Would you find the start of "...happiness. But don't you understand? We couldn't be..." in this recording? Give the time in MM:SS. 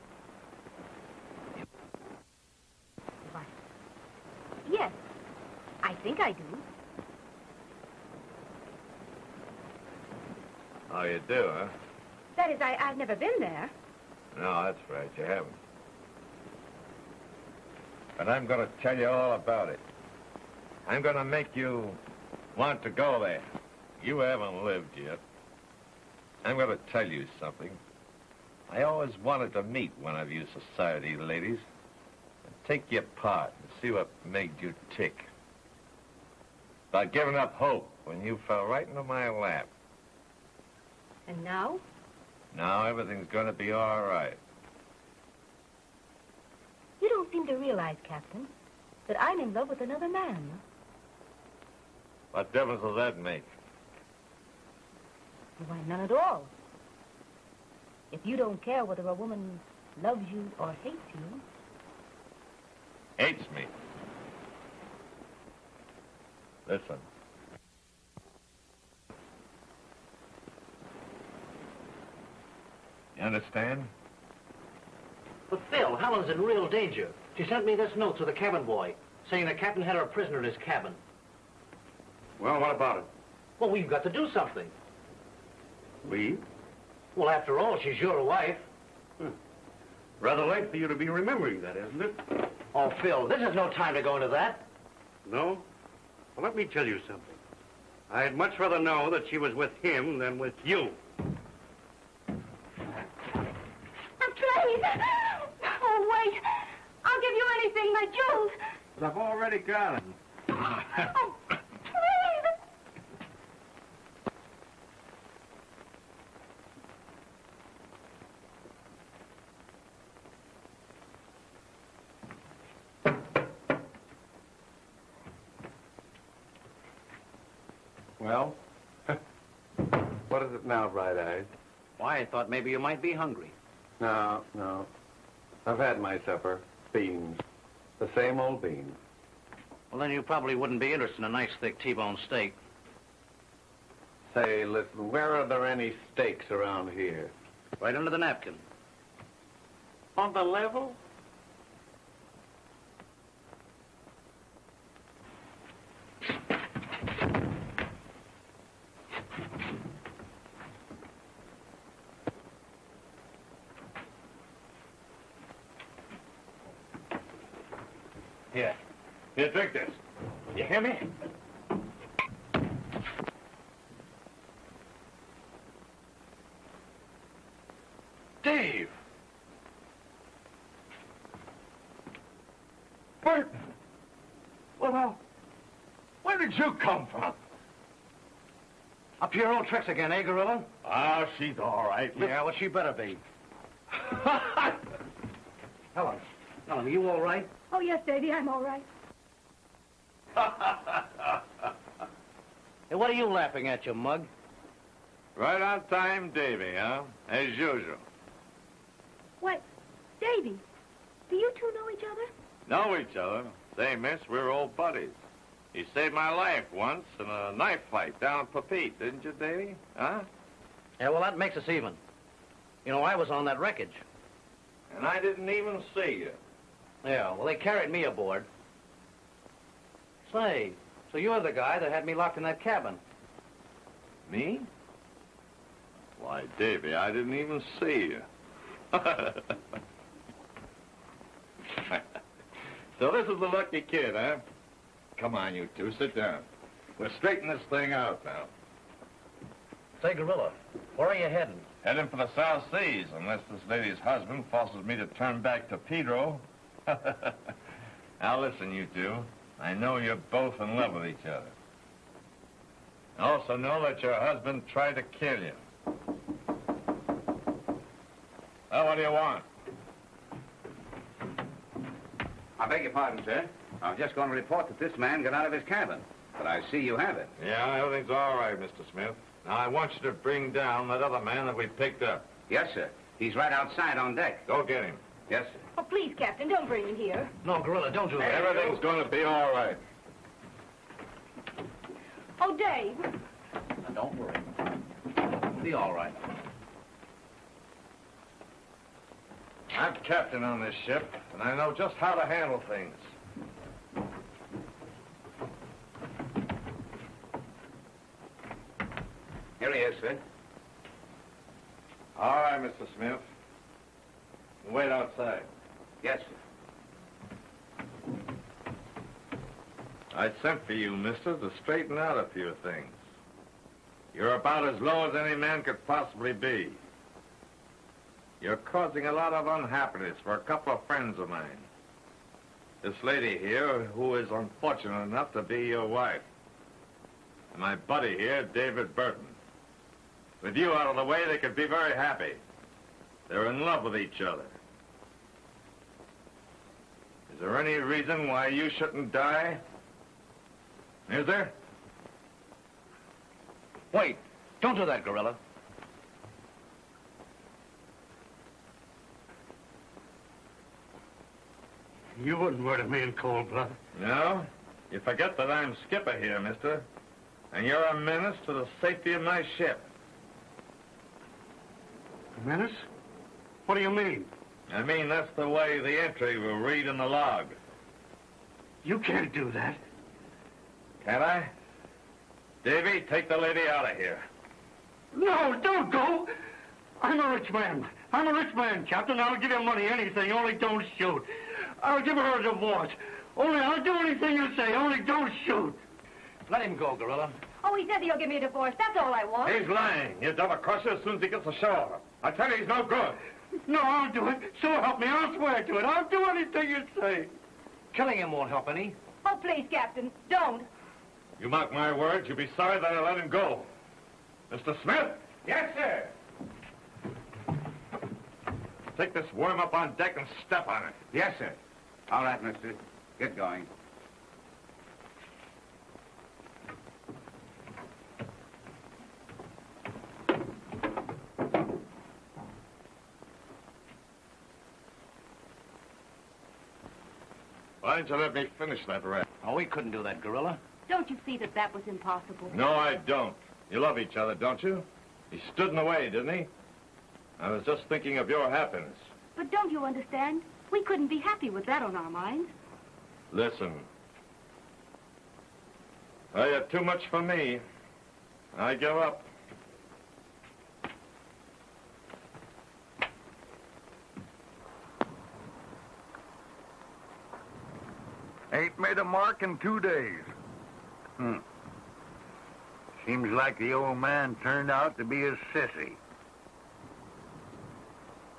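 07:28.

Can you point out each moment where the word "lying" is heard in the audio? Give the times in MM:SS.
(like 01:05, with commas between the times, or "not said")
06:39.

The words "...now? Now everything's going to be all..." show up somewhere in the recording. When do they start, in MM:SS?
00:41.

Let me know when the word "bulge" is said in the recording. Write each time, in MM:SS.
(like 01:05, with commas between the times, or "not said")
not said.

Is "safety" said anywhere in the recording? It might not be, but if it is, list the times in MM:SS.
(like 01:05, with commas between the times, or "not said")
06:08.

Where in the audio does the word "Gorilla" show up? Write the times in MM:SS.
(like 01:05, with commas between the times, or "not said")
03:10, 04:10, 04:47, 05:55, 06:36, 07:20.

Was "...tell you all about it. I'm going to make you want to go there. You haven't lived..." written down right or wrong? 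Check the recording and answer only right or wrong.
right.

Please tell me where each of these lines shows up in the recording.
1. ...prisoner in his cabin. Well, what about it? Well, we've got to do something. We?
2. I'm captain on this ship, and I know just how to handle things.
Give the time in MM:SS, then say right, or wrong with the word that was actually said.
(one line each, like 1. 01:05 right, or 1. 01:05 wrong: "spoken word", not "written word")
1. 01:20 right
2. 04:59 right.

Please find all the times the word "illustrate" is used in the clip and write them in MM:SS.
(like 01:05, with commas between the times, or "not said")
not said.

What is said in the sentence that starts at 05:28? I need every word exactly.
You're causing a lot of unhappiness for a couple of friends of mine.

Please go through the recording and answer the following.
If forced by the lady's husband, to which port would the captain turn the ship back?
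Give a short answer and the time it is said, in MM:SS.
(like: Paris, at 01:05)
Pedro, at 04:15.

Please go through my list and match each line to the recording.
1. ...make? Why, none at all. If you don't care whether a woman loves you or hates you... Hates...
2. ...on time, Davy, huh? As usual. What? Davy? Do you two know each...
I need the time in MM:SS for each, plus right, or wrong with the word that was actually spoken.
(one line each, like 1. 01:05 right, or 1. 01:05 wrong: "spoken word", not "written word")
1. 00:53 right
2. 03:25 right.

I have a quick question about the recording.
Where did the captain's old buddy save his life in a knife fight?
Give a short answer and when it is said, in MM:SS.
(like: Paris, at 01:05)
Papeete, at 03:38.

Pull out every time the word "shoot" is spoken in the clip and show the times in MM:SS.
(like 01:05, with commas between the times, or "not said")
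06:30, 06:35.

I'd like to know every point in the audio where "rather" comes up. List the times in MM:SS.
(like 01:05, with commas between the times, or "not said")
01:30, 01:38.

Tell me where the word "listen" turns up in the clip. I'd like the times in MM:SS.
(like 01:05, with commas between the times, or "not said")
01:06, 02:24, 04:18, 07:33.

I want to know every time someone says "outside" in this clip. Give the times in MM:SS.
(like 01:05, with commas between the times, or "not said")
04:43, 05:14.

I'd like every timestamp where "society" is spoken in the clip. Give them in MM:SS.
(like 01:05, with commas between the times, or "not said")
00:30.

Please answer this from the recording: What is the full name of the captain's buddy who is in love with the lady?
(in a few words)
David Burton.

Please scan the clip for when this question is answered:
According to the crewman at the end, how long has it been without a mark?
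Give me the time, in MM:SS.
07:49.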